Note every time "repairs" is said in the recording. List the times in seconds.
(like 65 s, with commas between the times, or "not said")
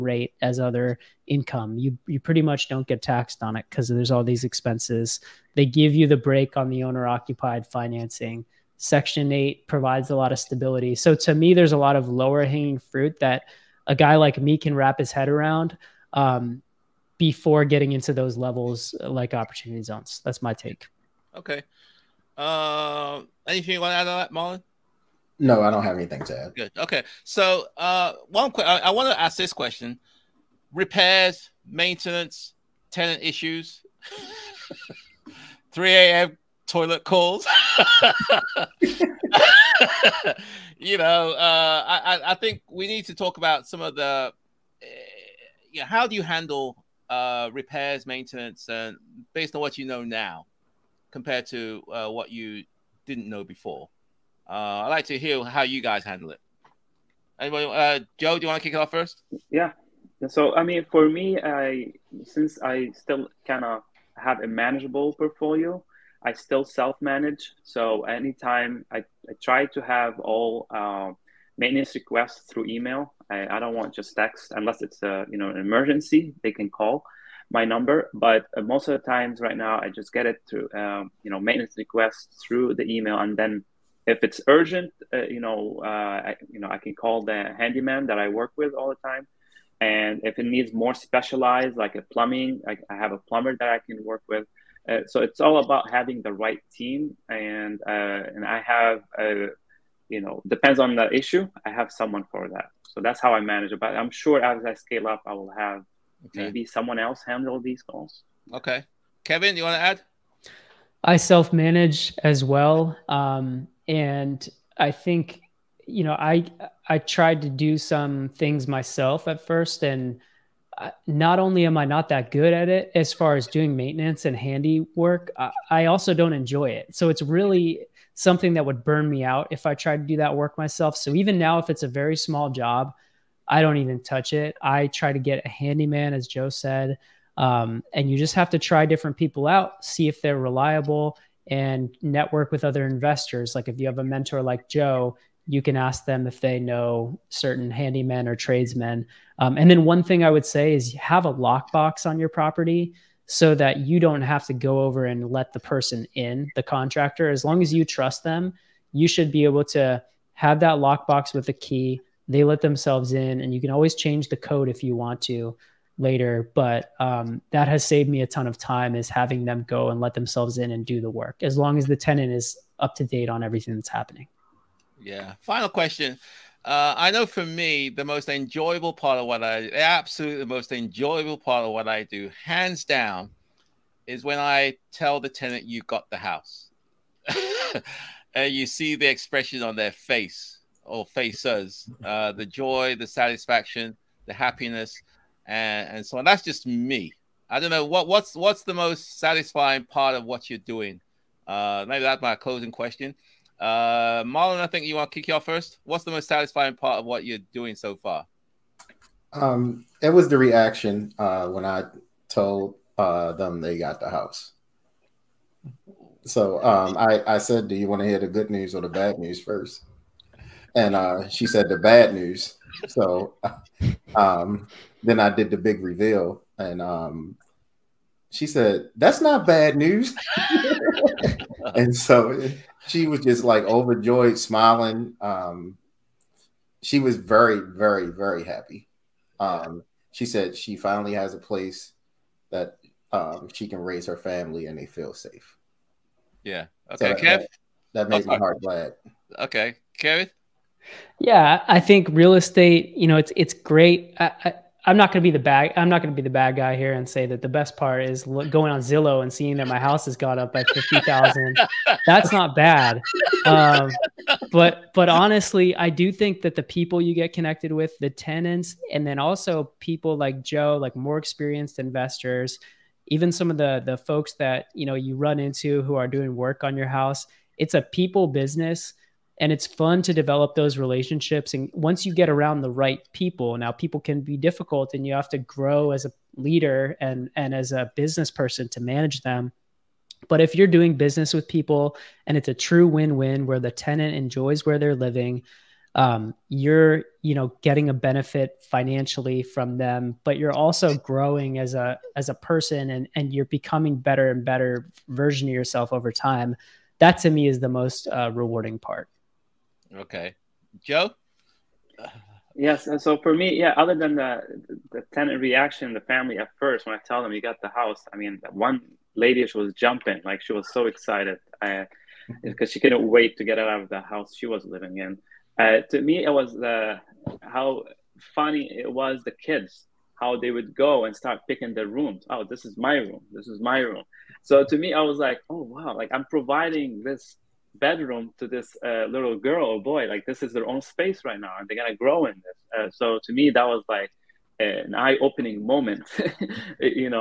30 s, 47 s.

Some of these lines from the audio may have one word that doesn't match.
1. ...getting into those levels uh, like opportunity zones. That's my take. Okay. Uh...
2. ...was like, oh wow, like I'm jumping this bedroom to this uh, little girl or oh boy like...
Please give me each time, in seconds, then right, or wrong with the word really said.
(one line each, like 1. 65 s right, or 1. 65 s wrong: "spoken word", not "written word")
1. 17 s right
2. 335 s wrong: "providing", not "jumping".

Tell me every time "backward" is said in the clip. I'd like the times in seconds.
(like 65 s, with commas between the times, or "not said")
not said.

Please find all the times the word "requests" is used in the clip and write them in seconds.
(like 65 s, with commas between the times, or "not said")
71 s, 81 s.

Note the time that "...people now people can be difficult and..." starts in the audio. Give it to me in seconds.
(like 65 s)
283 s.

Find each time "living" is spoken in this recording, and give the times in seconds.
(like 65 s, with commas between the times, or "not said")
294 s, 324 s.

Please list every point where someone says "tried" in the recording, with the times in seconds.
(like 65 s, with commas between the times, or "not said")
116 s, 129 s.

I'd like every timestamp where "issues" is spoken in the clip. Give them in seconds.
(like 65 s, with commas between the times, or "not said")
33 s, 101 s.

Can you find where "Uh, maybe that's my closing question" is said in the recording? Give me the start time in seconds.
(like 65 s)
201 s.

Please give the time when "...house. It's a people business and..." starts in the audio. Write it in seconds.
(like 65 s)
276 s.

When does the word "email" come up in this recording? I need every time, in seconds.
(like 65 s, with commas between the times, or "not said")
72 s, 82 s.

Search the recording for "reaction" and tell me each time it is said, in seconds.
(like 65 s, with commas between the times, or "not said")
210 s, 315 s.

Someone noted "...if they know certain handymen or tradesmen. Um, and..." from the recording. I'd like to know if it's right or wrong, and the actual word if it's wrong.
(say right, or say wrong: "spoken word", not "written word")
right.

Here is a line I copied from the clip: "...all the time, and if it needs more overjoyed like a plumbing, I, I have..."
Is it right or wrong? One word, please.
wrong.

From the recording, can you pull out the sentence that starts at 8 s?
Section 8 provides a lot of stability.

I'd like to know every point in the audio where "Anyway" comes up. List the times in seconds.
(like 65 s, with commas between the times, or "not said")
57 s.